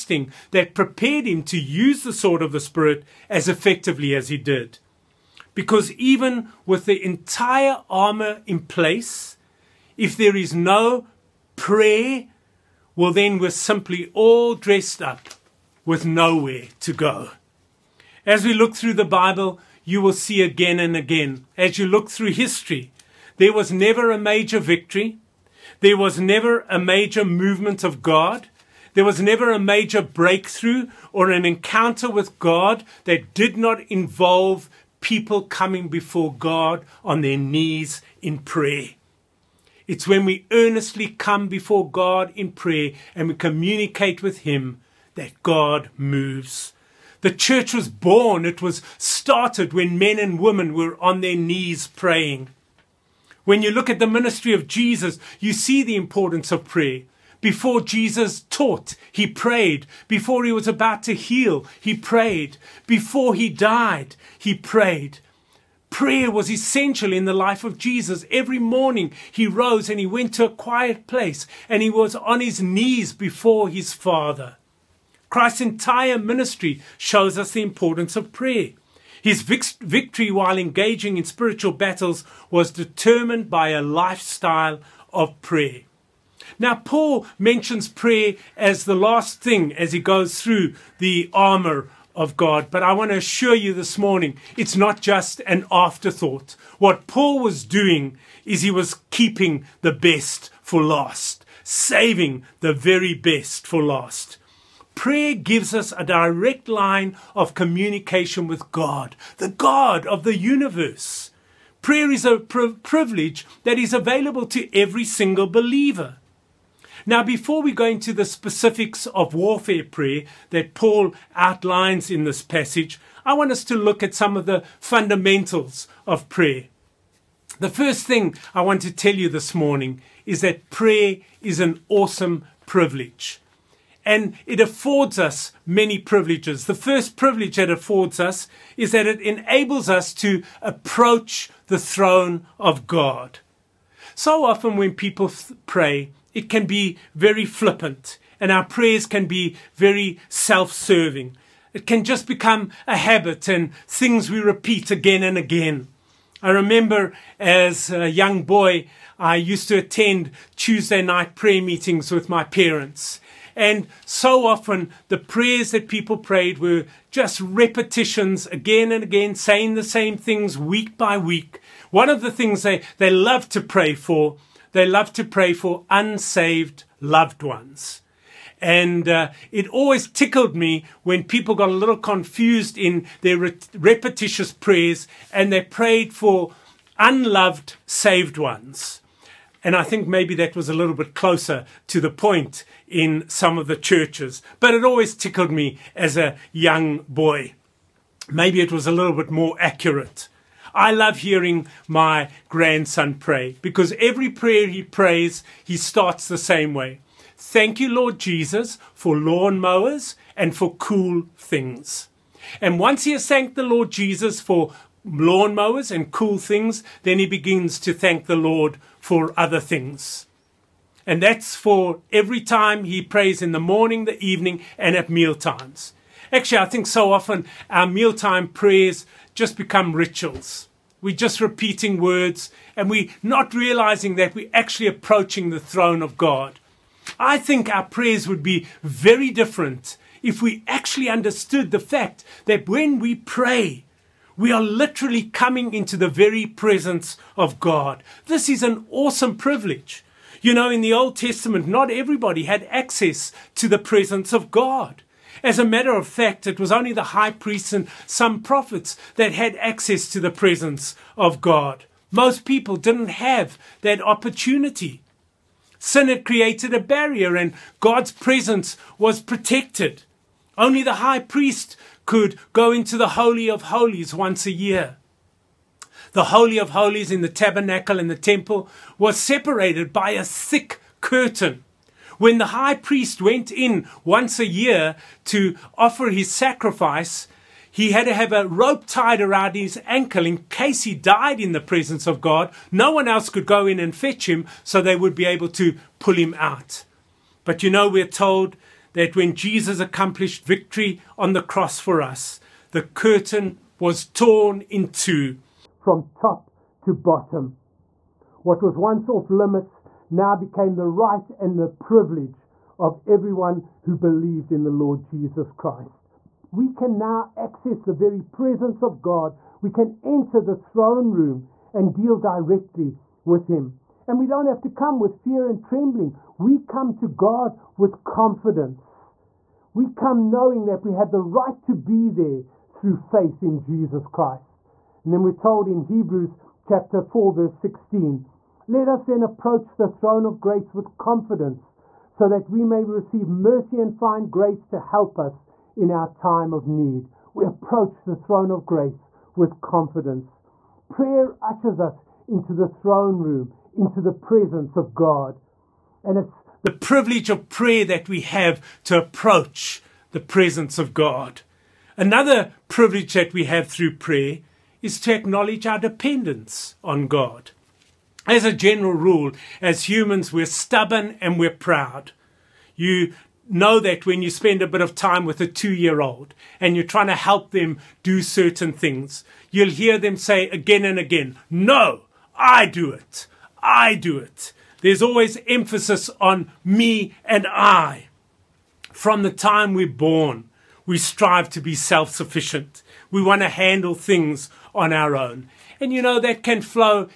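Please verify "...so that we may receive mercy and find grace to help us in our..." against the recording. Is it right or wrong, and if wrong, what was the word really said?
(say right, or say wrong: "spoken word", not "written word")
right.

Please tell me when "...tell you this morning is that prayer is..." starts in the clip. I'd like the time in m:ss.
2:08.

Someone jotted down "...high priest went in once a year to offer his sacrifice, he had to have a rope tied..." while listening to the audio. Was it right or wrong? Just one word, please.
right.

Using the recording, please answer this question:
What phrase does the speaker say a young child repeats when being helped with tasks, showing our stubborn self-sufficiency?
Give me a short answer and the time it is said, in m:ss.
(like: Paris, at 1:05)
No, I do it, at 6:21.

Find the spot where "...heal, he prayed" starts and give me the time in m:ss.
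1:01.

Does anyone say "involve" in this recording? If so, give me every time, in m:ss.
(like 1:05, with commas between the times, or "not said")
0:33.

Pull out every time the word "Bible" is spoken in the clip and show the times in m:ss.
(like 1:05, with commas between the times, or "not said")
0:19.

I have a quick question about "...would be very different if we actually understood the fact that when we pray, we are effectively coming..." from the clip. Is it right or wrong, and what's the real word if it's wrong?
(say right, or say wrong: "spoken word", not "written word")
wrong: "literally", not "effectively".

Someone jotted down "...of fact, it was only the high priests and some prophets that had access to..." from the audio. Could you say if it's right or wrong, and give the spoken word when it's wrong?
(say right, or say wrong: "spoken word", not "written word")
right.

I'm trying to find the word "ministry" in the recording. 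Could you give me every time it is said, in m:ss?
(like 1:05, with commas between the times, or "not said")
0:54, 1:16.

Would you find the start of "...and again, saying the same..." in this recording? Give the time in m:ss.
2:48.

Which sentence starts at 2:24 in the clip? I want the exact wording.
So often, when people pray, it can be very flippant, and our prayers can be very self serving.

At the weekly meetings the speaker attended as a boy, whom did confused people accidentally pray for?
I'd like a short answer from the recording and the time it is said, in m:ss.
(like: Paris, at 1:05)
unloved saved ones, at 3:06.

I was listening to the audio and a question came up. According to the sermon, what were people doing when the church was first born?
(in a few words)
on their knees praying.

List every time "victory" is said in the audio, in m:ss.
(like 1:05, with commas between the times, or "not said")
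0:24, 1:19, 5:00.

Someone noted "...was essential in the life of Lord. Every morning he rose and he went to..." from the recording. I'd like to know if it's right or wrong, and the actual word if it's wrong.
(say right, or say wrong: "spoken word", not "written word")
wrong: "Jesus", not "Lord".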